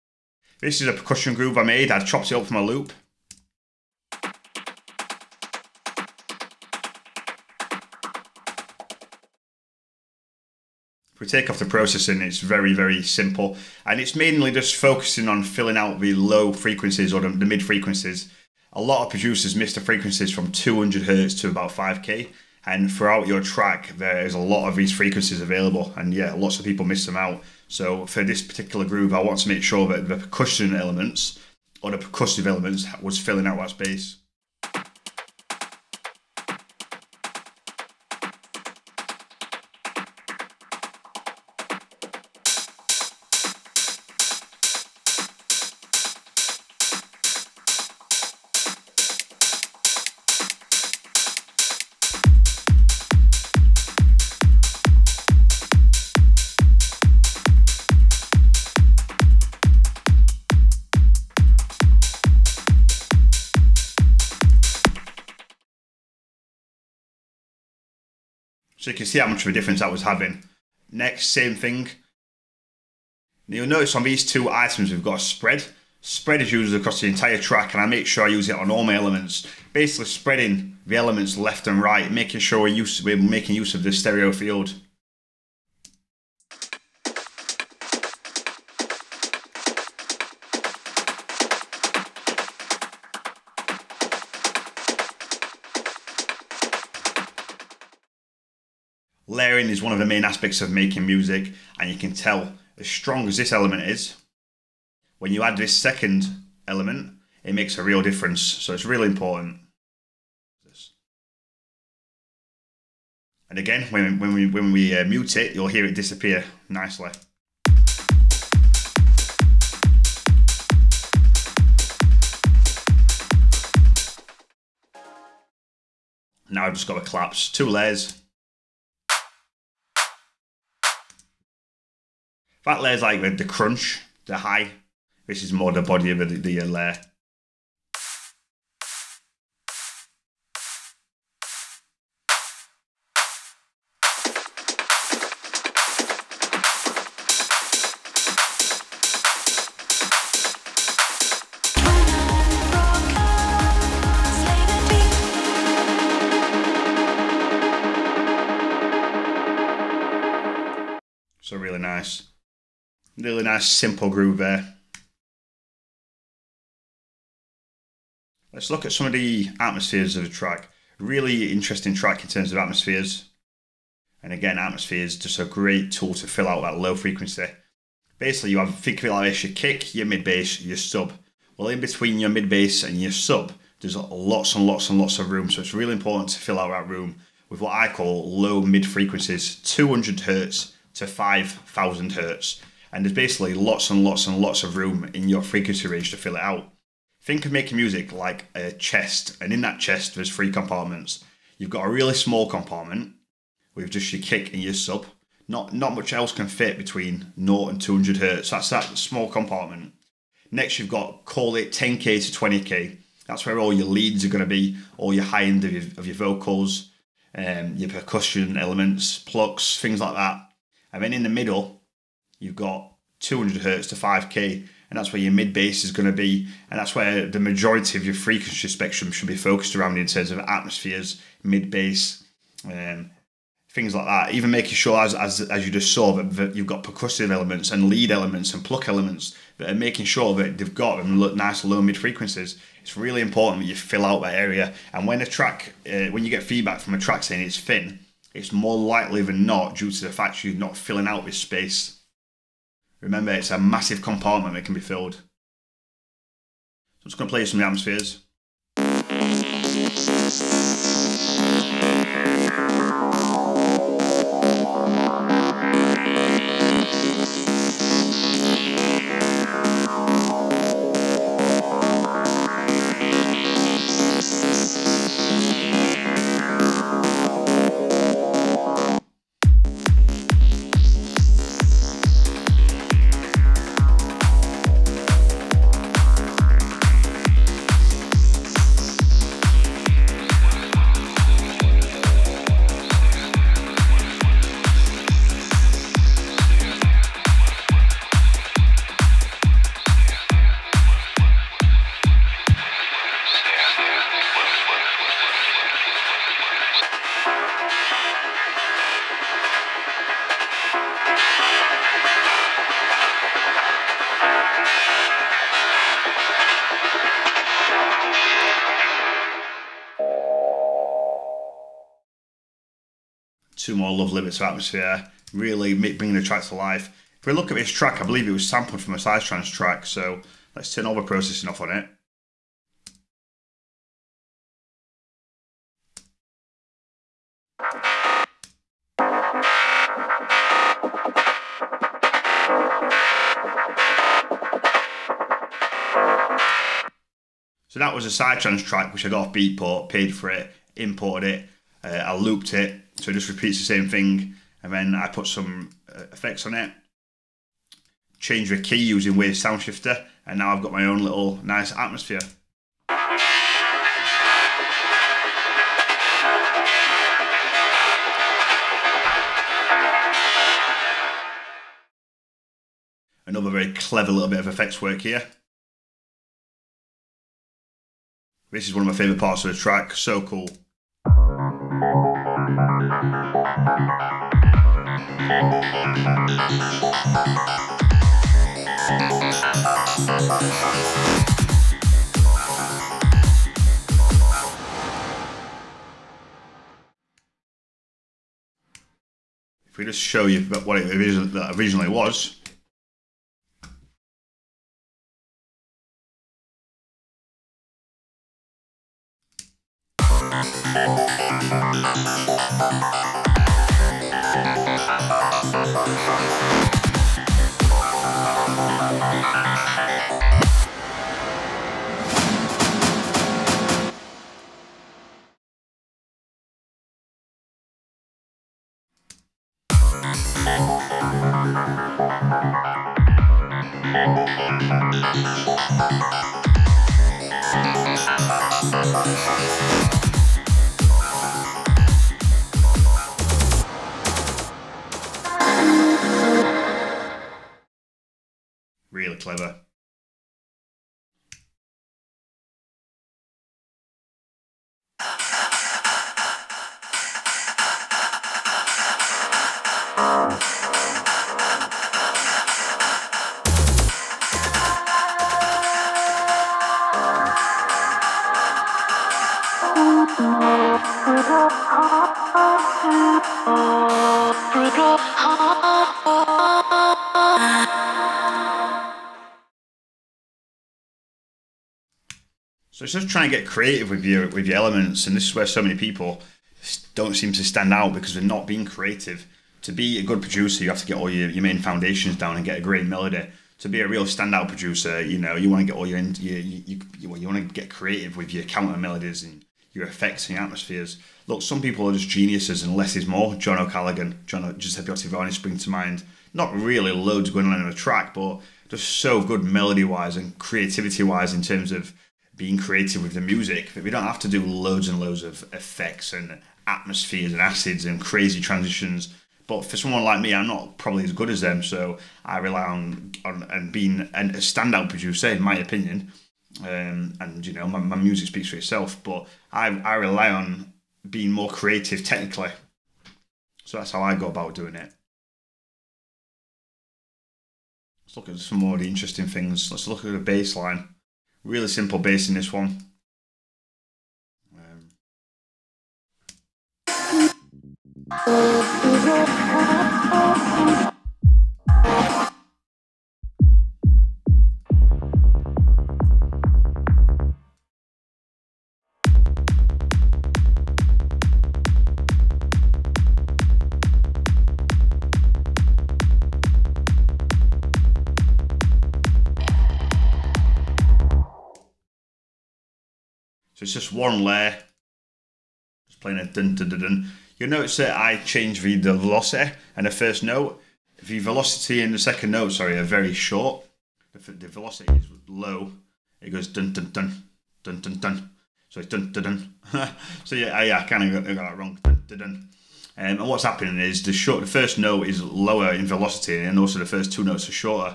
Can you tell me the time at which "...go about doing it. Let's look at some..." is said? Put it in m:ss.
8:54.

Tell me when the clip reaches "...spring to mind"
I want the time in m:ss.
8:25.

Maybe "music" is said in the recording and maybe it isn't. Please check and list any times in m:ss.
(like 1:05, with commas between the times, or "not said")
1:41, 3:17, 8:33, 8:47.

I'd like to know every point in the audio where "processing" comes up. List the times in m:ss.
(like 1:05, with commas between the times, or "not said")
0:11, 5:31.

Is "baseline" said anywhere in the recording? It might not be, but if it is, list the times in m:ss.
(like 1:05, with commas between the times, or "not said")
9:00.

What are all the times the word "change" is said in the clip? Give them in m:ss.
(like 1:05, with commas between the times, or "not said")
5:58, 9:38.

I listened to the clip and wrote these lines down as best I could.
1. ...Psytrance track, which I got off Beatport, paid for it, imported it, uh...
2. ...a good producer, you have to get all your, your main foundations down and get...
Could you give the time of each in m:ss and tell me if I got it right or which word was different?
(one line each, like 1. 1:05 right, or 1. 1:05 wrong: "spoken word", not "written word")
1. 5:48 right
2. 8:09 right.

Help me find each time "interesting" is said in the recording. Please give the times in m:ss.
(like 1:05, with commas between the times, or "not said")
2:51, 8:58.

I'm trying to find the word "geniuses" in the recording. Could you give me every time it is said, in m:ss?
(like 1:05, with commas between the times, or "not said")
8:22.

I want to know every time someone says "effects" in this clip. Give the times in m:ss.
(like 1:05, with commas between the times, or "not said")
5:56, 6:14, 8:19, 8:35.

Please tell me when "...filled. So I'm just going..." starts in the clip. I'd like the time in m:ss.
4:14.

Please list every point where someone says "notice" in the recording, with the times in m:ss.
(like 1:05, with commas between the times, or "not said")
1:13, 9:37.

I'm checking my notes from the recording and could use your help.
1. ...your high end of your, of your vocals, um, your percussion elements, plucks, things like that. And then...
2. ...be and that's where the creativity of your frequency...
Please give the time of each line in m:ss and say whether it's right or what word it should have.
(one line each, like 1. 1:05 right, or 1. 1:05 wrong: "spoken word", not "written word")
1. 3:35 right
2. 3:46 wrong: "majority", not "creativity".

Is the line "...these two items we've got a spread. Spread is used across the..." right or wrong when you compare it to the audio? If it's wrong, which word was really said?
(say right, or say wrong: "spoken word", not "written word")
right.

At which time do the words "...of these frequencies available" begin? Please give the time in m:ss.
0:24.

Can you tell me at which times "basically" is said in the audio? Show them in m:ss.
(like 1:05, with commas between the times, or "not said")
1:19, 2:58, 3:13.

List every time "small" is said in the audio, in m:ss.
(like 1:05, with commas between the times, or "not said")
3:22, 3:28.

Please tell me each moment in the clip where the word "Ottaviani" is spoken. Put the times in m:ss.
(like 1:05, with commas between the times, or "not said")
8:24.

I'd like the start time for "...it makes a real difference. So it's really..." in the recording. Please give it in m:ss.
1:47.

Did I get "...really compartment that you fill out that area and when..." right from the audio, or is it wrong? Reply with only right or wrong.
wrong.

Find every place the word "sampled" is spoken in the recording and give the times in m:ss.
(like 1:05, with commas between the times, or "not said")
5:28.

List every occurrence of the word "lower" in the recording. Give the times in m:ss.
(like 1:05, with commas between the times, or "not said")
9:55.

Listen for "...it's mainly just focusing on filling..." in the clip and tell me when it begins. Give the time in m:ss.
0:13.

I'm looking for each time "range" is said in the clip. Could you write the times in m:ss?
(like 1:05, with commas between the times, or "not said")
3:15.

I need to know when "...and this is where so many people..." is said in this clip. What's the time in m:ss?
8:05.